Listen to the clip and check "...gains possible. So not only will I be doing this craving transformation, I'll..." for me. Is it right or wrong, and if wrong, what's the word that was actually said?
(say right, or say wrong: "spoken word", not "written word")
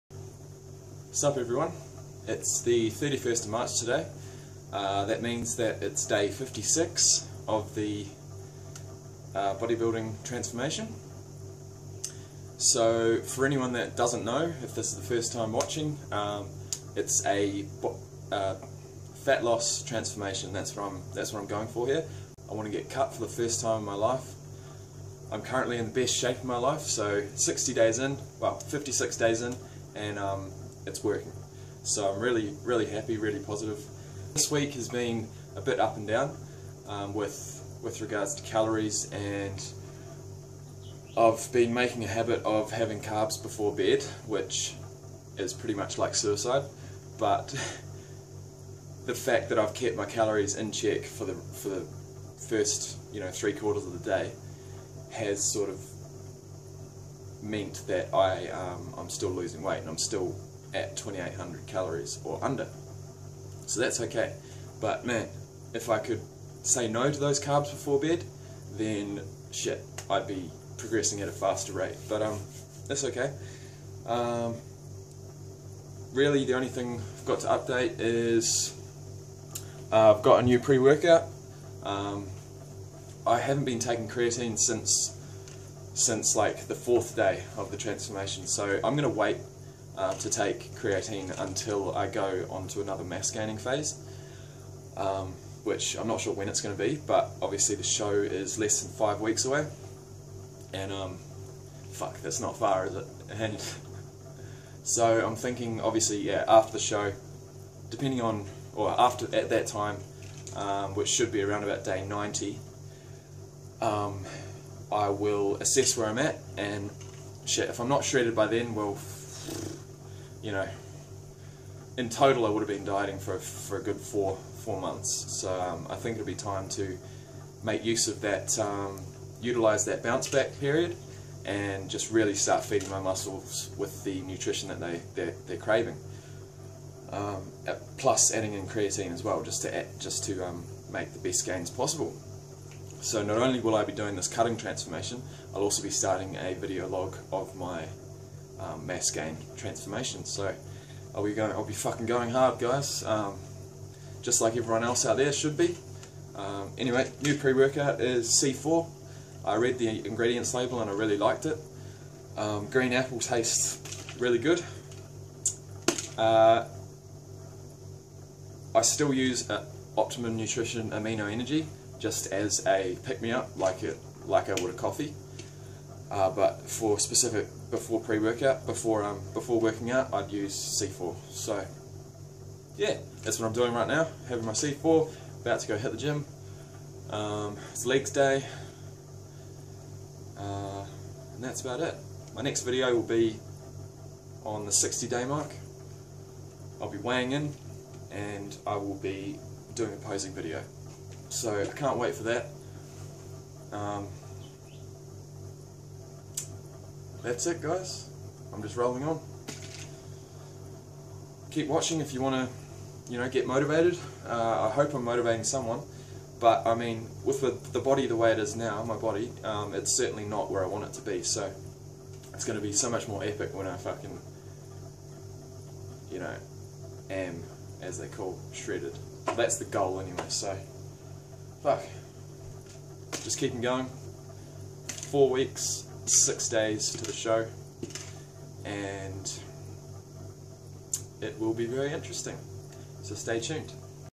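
wrong: "cutting", not "craving".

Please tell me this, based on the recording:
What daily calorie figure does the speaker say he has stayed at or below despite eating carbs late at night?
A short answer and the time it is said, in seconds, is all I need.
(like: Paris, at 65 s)
2800, at 60 s.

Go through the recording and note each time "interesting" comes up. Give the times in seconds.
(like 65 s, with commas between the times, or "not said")
241 s.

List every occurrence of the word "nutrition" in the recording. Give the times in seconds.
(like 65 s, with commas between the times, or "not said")
134 s, 170 s.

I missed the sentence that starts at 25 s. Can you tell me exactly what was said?
I'm currently in the best shape of my life, so 60 days in, well 56 days in, and um, it's working.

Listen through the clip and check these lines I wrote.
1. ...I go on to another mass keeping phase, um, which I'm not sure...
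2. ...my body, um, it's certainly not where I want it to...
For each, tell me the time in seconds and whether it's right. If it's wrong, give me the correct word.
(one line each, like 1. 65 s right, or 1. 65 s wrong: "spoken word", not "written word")
1. 91 s wrong: "gaining", not "keeping"
2. 218 s right.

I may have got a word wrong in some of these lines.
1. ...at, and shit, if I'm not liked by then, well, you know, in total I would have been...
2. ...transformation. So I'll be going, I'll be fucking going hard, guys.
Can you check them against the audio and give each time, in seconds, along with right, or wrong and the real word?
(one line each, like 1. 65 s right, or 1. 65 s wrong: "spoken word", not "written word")
1. 116 s wrong: "shredded", not "liked"
2. 149 s right.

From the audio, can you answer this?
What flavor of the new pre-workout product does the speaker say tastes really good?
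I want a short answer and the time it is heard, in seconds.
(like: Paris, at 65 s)
Green apple, at 162 s.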